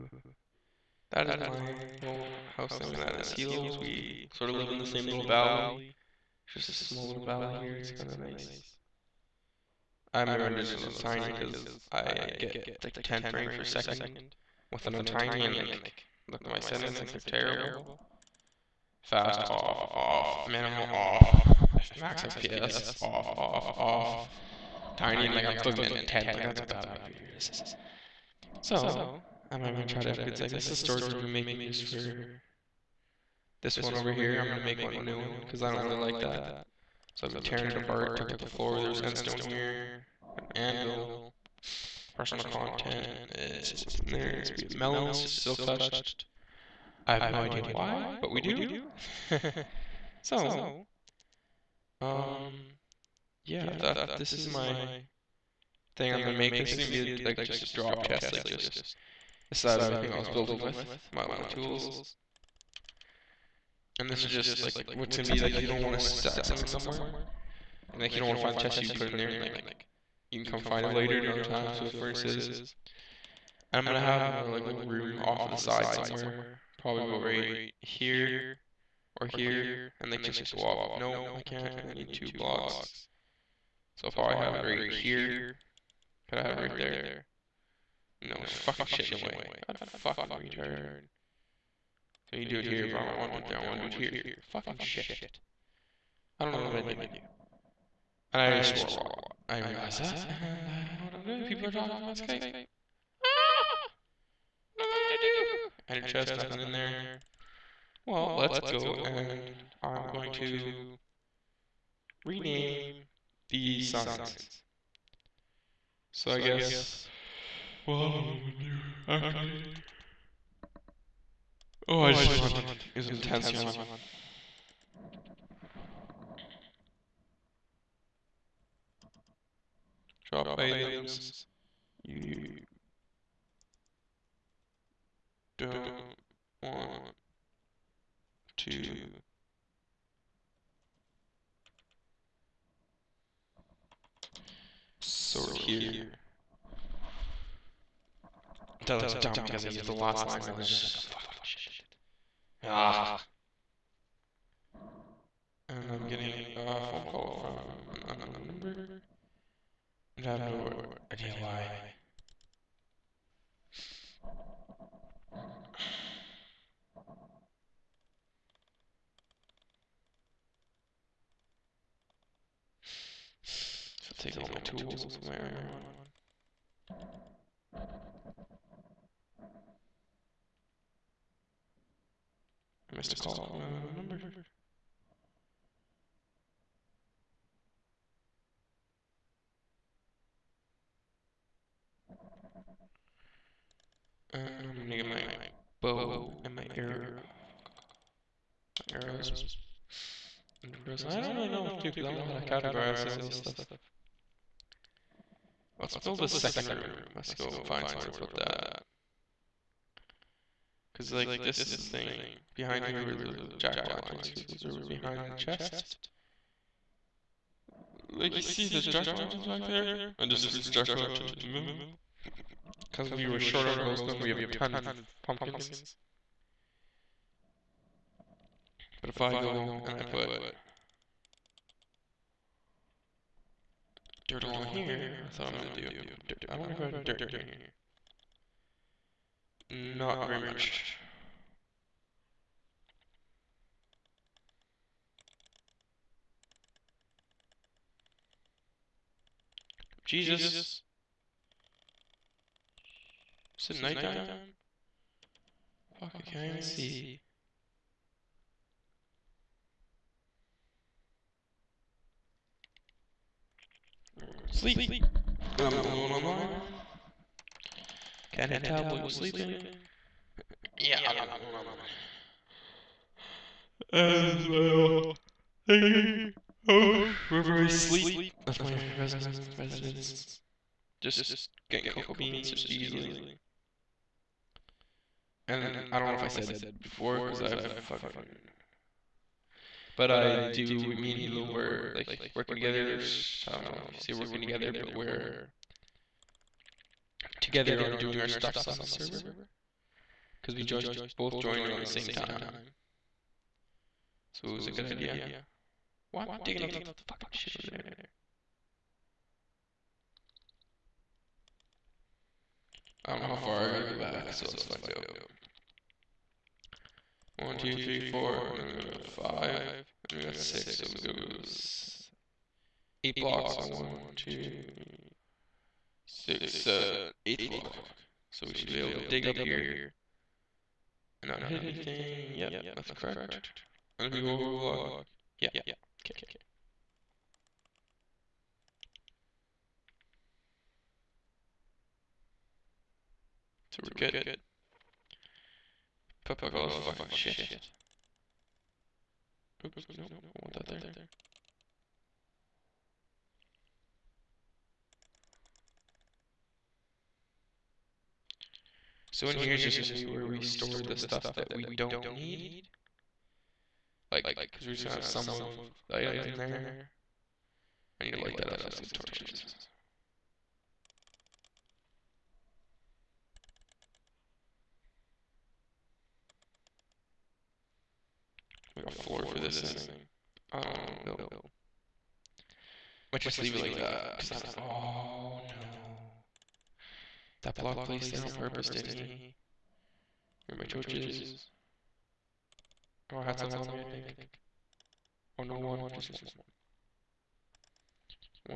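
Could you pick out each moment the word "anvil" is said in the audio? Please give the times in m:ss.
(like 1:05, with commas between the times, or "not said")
0:40.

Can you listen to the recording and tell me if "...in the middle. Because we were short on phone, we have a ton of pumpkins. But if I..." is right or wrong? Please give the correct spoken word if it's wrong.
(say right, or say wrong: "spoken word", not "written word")
wrong: "glowstone", not "phone".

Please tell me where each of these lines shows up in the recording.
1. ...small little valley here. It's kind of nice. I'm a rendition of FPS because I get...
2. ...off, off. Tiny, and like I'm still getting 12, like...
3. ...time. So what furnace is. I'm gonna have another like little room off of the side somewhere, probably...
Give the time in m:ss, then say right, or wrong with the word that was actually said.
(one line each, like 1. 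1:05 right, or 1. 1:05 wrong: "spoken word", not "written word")
1. 0:06 wrong: "Tiny", not "FPS"
2. 0:23 wrong: "10", not "12"
3. 1:11 right.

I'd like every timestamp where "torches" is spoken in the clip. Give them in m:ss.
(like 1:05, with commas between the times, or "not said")
6:08, 6:30.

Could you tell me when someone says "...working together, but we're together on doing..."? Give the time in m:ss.
4:54.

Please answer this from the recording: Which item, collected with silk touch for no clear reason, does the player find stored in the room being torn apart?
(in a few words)
melons.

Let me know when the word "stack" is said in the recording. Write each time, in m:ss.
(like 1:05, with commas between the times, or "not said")
1:06.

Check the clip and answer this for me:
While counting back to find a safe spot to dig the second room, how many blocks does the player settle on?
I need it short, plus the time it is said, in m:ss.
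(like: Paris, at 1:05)
8, at 5:23.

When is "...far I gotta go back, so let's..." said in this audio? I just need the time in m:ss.
5:13.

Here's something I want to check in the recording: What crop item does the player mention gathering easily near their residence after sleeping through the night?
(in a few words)
cocoa beans.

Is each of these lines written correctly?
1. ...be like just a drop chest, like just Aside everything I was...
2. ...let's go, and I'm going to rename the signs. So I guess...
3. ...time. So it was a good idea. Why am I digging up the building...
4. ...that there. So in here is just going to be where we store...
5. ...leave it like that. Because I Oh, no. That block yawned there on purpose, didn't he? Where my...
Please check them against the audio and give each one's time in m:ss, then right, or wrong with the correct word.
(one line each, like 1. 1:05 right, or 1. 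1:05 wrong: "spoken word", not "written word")
1. 0:57 right
2. 1:48 right
3. 5:02 wrong: "fucking", not "building"
4. 5:50 right
5. 6:23 wrong: "placed", not "yawned".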